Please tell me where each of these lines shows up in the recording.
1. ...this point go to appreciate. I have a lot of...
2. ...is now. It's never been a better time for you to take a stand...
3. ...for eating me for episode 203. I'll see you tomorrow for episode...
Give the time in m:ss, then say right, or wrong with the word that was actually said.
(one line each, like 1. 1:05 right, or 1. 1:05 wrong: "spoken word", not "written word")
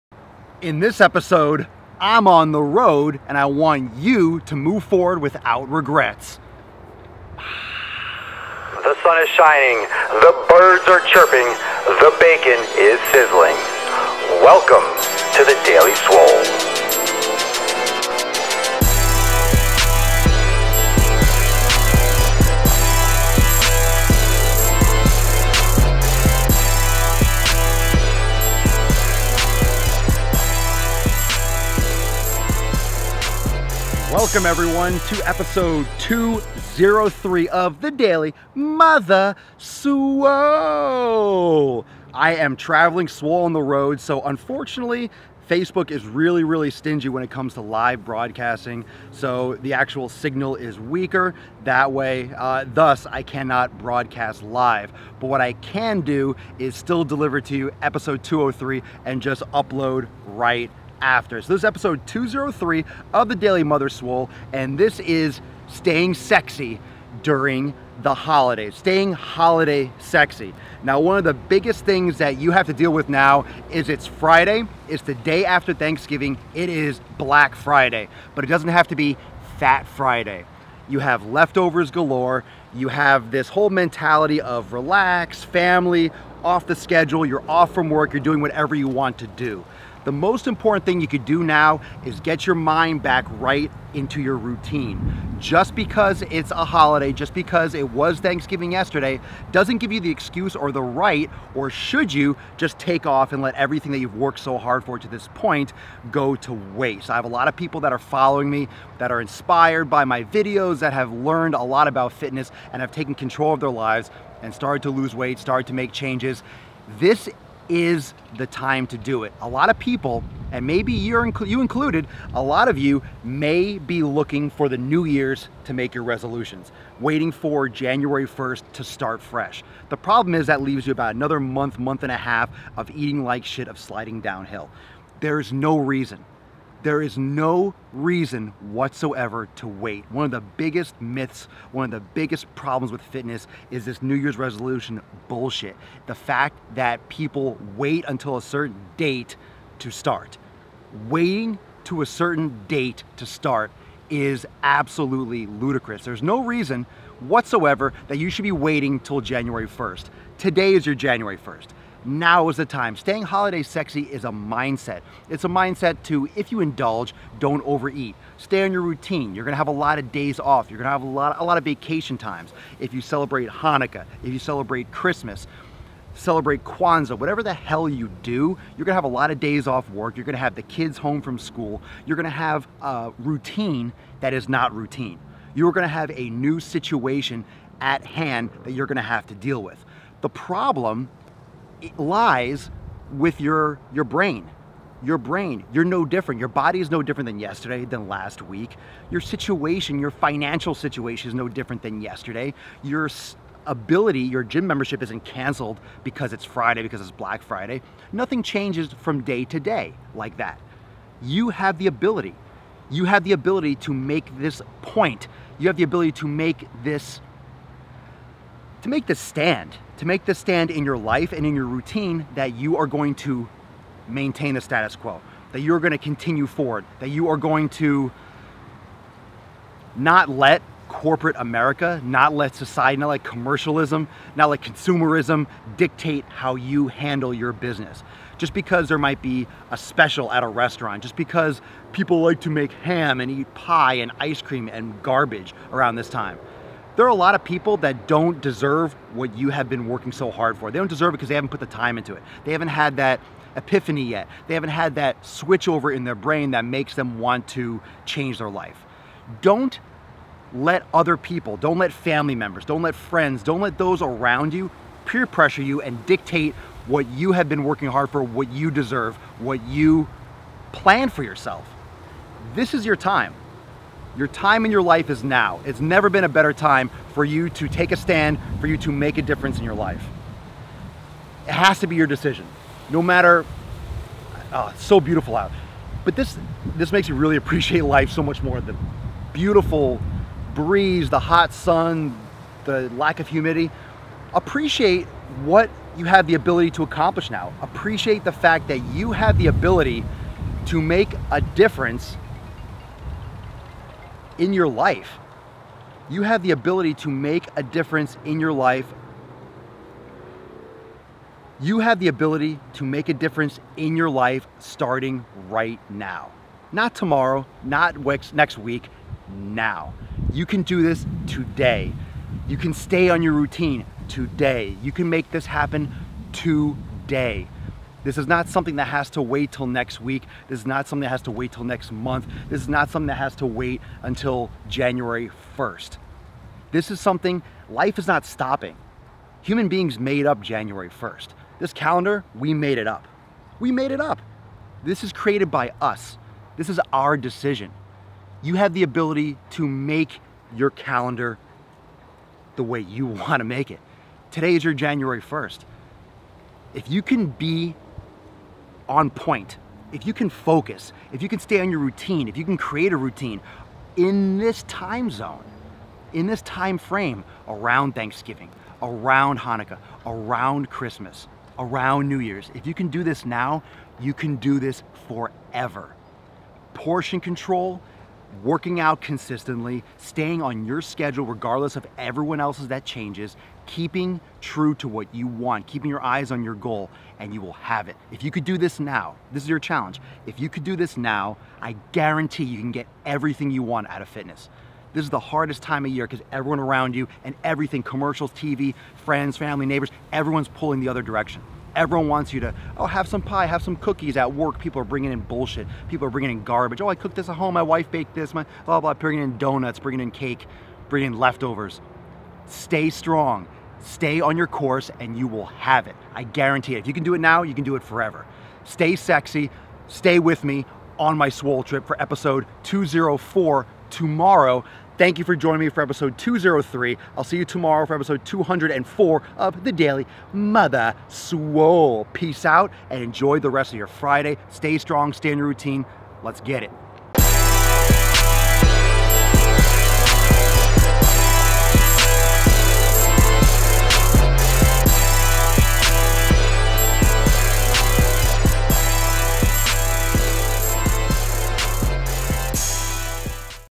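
1. 1:45 wrong: "waste", not "appreciate"
2. 4:35 right
3. 7:05 wrong: "joining", not "eating".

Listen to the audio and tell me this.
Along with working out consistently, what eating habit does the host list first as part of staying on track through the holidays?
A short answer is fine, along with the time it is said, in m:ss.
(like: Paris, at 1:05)
Portion control, at 6:16.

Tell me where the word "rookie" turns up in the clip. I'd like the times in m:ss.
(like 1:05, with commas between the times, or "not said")
not said.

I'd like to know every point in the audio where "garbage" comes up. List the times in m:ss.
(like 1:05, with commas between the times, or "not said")
4:05, 6:46.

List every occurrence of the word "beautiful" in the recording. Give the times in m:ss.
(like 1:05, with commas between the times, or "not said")
4:44, 4:49.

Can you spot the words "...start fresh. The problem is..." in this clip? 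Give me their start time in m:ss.
2:08.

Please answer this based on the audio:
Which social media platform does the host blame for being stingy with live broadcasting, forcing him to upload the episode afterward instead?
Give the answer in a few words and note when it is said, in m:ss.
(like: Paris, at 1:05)
Facebook, at 0:45.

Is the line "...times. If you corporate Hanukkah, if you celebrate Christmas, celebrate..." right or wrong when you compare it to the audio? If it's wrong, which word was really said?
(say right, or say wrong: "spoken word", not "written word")
wrong: "celebrate", not "corporate".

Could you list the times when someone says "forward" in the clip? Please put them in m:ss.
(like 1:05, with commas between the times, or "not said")
0:04, 3:46.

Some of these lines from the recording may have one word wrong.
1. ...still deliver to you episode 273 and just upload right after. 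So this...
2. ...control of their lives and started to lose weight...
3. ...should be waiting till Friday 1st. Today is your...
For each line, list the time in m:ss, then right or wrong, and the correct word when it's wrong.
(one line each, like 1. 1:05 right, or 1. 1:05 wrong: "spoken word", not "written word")
1. 0:56 wrong: "203", not "273"
2. 1:53 right
3. 2:38 wrong: "January", not "Friday".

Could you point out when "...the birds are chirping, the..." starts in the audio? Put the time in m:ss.
0:10.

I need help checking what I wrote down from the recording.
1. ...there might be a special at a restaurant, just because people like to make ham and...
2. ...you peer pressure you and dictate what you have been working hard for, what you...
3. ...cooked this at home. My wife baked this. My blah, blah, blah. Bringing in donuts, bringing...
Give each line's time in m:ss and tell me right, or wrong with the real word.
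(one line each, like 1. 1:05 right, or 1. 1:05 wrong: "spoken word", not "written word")
1. 3:58 right
2. 4:24 right
3. 6:46 right.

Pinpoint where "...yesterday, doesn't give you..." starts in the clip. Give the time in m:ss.
1:38.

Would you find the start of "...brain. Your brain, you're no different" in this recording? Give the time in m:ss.
3:14.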